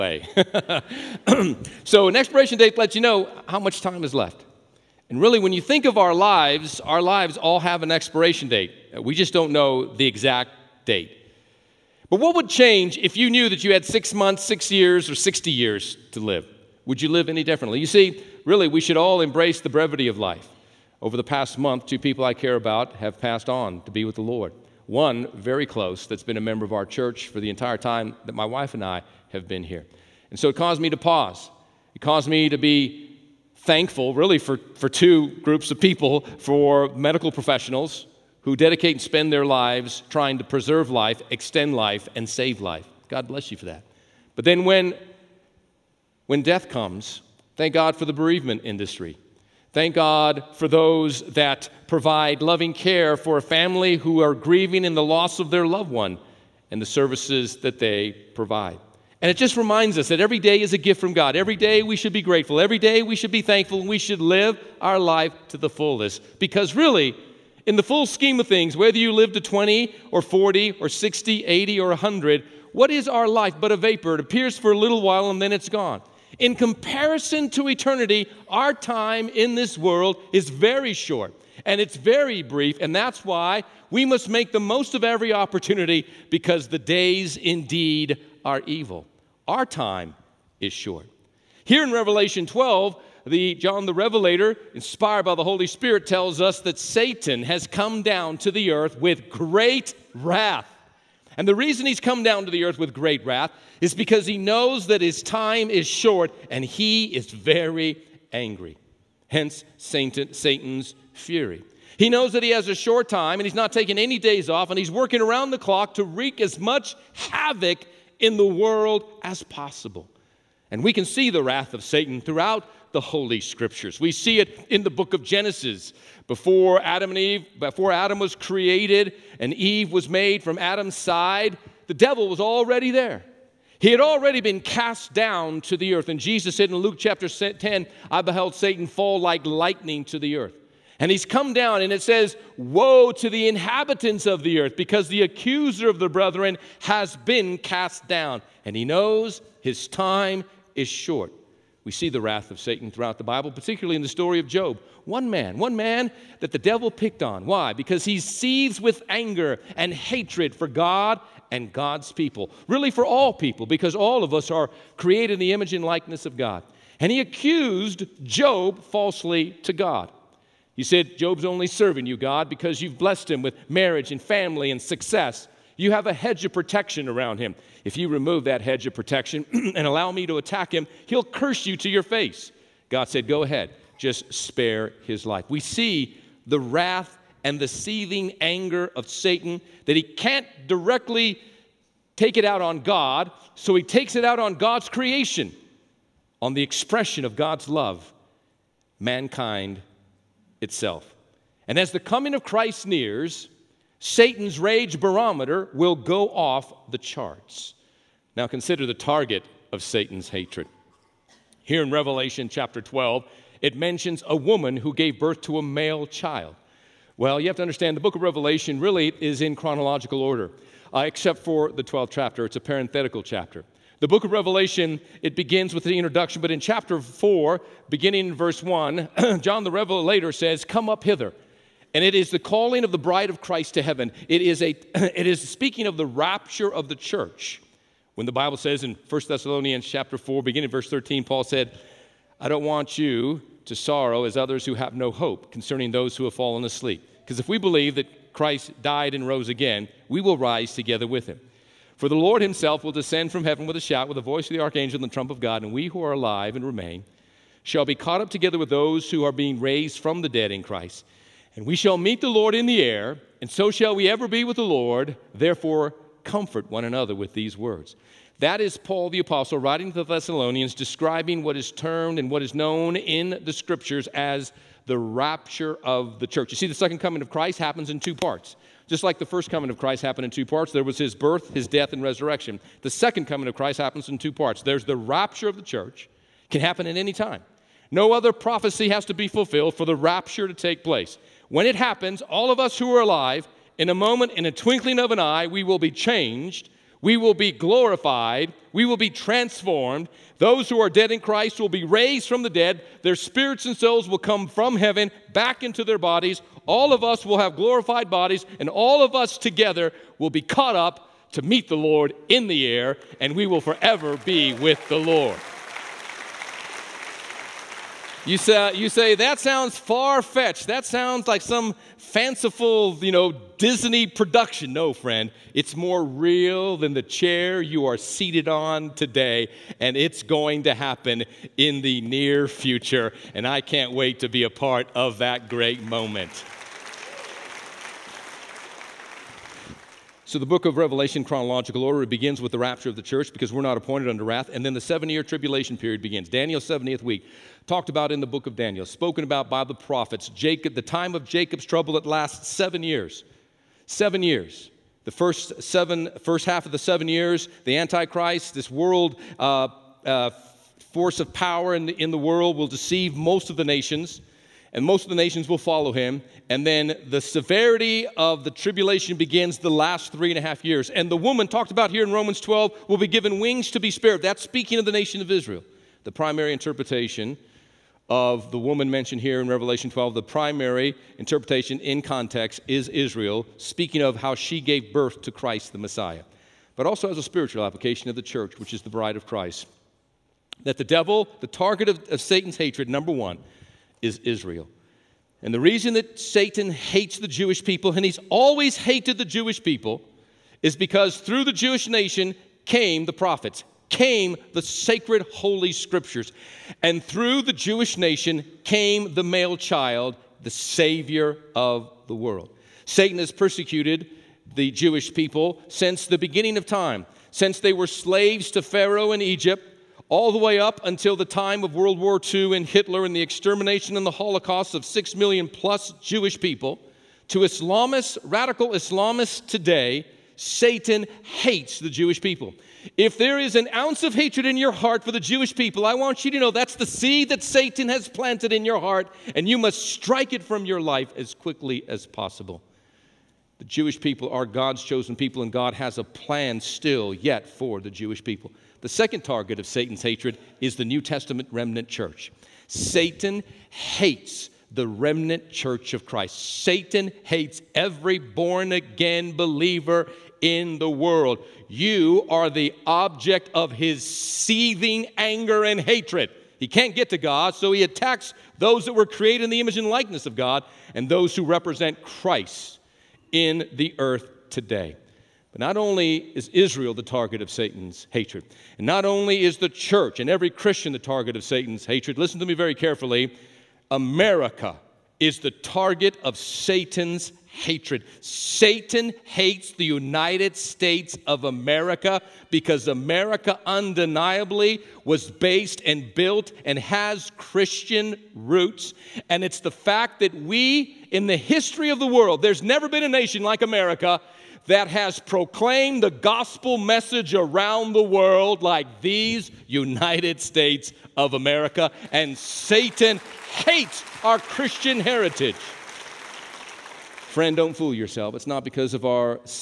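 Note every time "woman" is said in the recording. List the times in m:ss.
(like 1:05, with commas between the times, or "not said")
3:34, 6:11, 6:18.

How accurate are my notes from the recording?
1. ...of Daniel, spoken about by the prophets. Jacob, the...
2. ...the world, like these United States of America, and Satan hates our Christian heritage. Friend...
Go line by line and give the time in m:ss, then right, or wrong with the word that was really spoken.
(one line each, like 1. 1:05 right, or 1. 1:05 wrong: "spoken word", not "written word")
1. 5:48 right
2. 8:27 right.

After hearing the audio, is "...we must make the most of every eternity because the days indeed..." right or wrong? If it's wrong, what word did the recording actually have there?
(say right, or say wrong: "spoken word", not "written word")
wrong: "opportunity", not "eternity".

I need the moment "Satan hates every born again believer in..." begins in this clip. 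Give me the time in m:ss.
7:36.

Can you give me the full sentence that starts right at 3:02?
God said, Go ahead, just spare his life.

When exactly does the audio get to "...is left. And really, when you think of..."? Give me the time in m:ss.
0:04.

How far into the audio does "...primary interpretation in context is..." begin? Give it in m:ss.
6:20.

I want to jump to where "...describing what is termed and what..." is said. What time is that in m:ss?
4:30.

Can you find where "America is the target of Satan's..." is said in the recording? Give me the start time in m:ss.
8:03.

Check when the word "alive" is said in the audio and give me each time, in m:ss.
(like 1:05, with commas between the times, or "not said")
4:16, 4:53.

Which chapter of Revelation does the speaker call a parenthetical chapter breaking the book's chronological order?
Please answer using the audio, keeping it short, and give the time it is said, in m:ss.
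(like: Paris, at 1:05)
12th, at 3:41.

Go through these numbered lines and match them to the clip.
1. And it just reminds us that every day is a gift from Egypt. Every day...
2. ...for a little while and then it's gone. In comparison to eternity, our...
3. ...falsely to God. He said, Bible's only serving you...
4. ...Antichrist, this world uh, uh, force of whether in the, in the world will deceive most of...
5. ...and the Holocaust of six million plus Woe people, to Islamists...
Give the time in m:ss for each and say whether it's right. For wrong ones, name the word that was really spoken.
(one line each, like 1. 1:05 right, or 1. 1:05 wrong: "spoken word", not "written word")
1. 0:59 wrong: "God", not "Egypt"
2. 1:14 right
3. 2:48 wrong: "Job", not "Bible"
4. 5:57 wrong: "power", not "whether"
5. 7:03 wrong: "Jewish", not "Woe".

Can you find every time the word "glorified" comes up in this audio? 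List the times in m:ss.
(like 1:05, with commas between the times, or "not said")
4:57, 5:07.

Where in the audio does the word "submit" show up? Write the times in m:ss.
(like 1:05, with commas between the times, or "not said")
not said.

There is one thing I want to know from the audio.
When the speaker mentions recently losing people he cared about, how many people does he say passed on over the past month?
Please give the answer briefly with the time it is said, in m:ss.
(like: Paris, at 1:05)
2, at 0:21.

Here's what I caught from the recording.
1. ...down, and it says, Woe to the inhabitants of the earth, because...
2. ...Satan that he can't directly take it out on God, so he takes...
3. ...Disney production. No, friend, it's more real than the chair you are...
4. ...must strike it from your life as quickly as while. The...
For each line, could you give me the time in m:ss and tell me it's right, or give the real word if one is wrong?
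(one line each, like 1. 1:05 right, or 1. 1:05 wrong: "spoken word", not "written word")
1. 2:21 right
2. 3:09 right
3. 5:23 right
4. 7:19 wrong: "possible", not "while".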